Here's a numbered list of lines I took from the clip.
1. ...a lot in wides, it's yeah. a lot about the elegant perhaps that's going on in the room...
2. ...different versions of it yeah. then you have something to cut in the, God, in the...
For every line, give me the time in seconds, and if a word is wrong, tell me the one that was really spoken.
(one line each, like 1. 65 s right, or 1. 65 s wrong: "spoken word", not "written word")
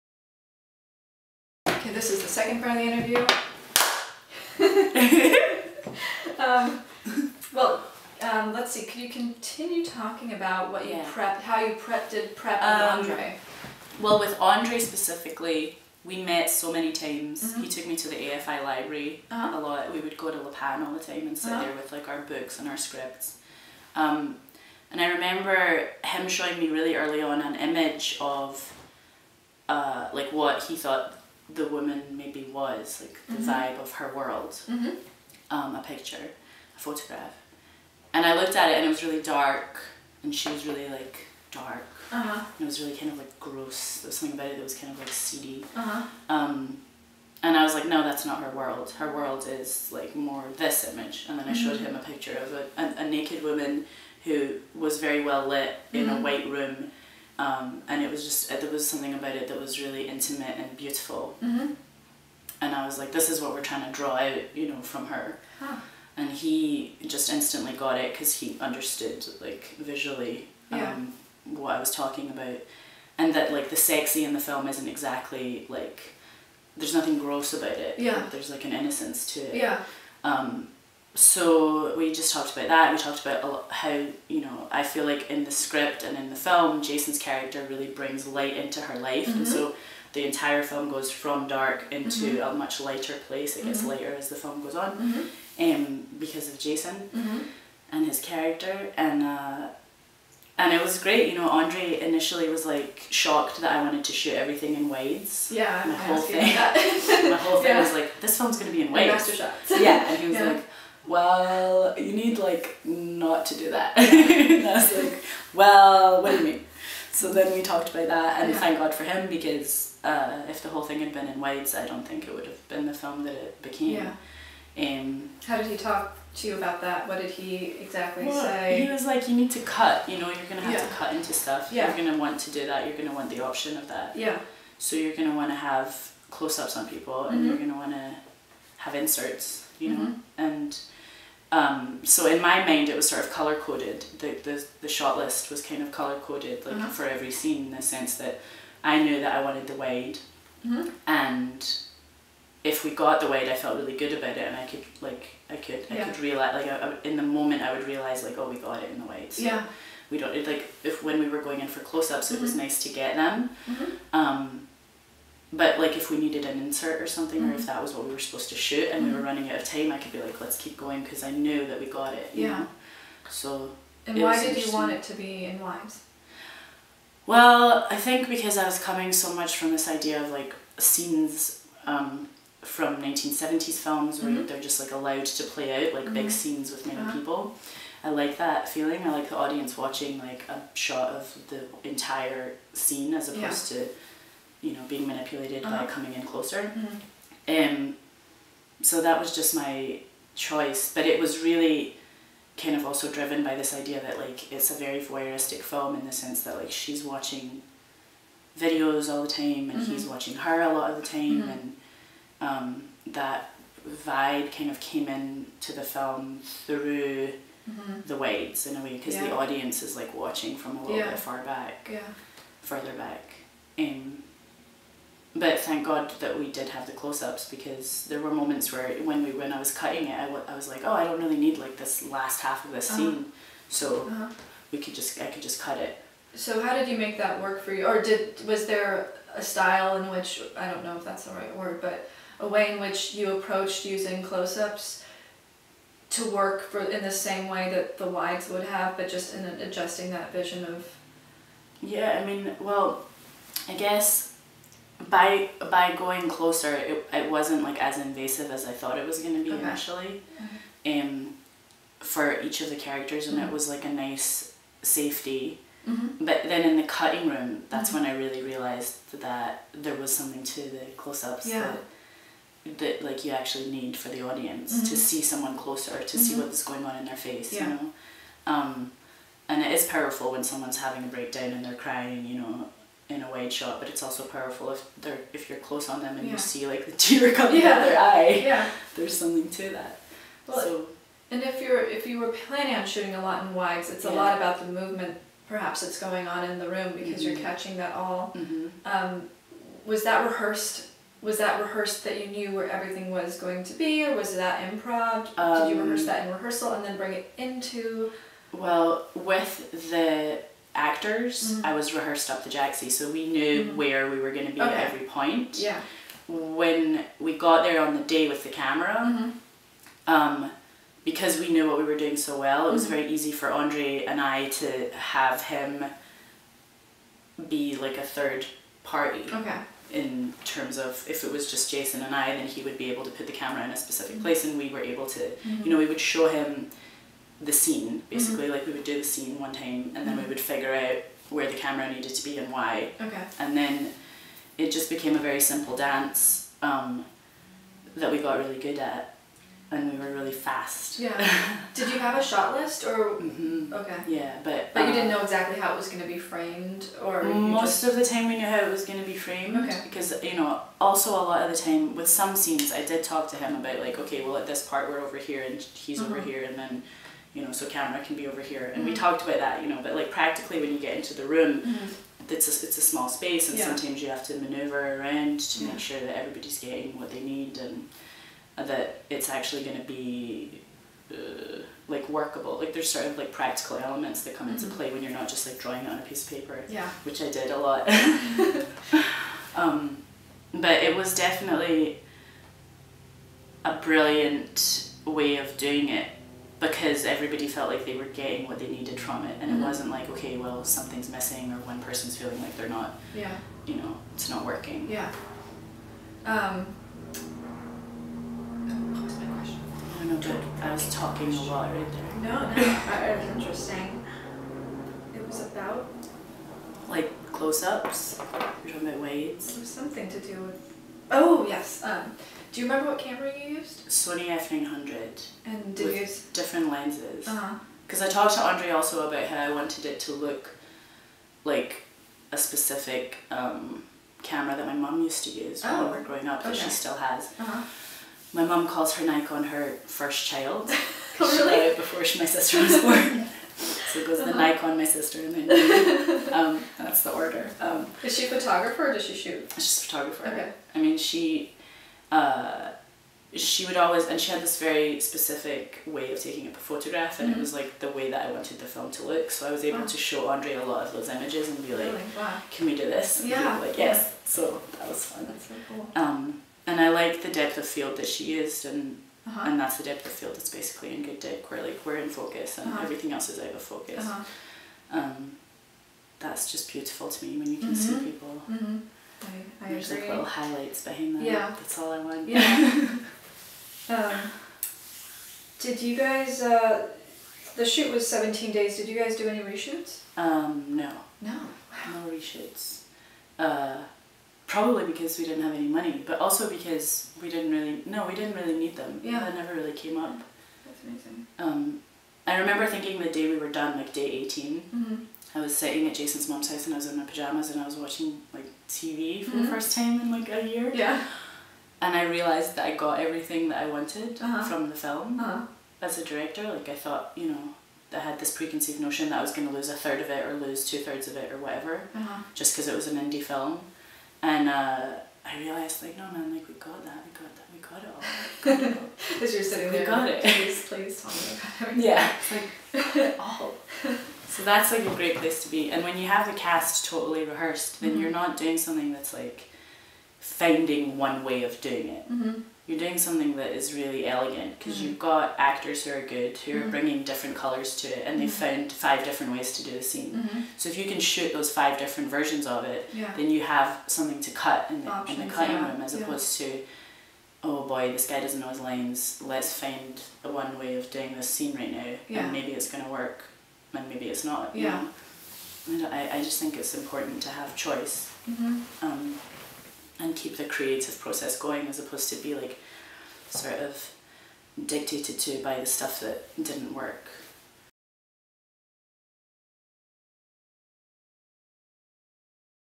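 1. 293 s wrong: "movement", not "elegant"
2. 551 s wrong: "Options", not "God".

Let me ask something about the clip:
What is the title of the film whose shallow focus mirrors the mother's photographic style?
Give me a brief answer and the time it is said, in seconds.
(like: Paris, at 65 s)
Good Dick, at 471 s.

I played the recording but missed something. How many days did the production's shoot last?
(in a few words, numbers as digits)
17.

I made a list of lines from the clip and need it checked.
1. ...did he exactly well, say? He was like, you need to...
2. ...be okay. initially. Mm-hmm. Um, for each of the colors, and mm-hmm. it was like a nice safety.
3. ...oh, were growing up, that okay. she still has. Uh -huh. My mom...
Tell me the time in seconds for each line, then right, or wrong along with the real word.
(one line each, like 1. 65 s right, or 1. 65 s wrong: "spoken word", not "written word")
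1. 127 s right
2. 259 s wrong: "characters", not "colors"
3. 435 s right.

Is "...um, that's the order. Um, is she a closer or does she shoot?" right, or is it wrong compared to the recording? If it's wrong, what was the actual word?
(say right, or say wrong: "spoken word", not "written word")
wrong: "photographer", not "closer".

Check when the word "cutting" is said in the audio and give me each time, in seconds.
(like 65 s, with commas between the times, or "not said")
229 s, 266 s, 555 s.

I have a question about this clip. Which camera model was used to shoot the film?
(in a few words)
Sony F900.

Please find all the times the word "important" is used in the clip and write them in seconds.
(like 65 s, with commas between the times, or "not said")
566 s.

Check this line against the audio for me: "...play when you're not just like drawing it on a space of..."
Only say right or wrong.
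wrong.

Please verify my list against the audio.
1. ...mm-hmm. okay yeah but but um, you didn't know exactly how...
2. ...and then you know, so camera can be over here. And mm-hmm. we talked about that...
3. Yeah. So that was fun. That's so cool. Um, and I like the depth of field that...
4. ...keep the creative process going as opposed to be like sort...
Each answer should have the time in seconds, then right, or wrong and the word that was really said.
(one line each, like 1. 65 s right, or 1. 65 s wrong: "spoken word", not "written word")
1. 353 s right
2. 366 s right
3. 464 s right
4. 570 s right.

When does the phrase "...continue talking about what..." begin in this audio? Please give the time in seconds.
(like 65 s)
9 s.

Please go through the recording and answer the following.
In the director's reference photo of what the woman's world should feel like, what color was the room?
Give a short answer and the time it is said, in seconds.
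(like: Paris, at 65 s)
White, at 56 s.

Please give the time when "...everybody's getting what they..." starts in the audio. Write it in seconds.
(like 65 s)
376 s.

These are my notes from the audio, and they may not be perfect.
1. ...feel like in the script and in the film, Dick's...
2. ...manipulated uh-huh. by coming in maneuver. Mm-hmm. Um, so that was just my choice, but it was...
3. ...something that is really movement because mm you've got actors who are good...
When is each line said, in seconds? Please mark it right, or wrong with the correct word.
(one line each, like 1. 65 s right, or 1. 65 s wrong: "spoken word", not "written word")
1. 84 s wrong: "Jason", not "Dick"
2. 195 s wrong: "closer", not "maneuver"
3. 542 s wrong: "elegant", not "movement".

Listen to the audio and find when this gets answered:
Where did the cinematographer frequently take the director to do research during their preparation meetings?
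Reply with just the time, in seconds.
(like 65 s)
18 s.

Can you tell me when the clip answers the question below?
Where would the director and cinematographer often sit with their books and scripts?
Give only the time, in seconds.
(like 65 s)
20 s.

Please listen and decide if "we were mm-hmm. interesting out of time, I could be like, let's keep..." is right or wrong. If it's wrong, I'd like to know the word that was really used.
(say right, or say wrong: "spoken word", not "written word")
wrong: "running", not "interesting".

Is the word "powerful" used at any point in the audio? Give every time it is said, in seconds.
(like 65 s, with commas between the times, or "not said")
279 s, 284 s.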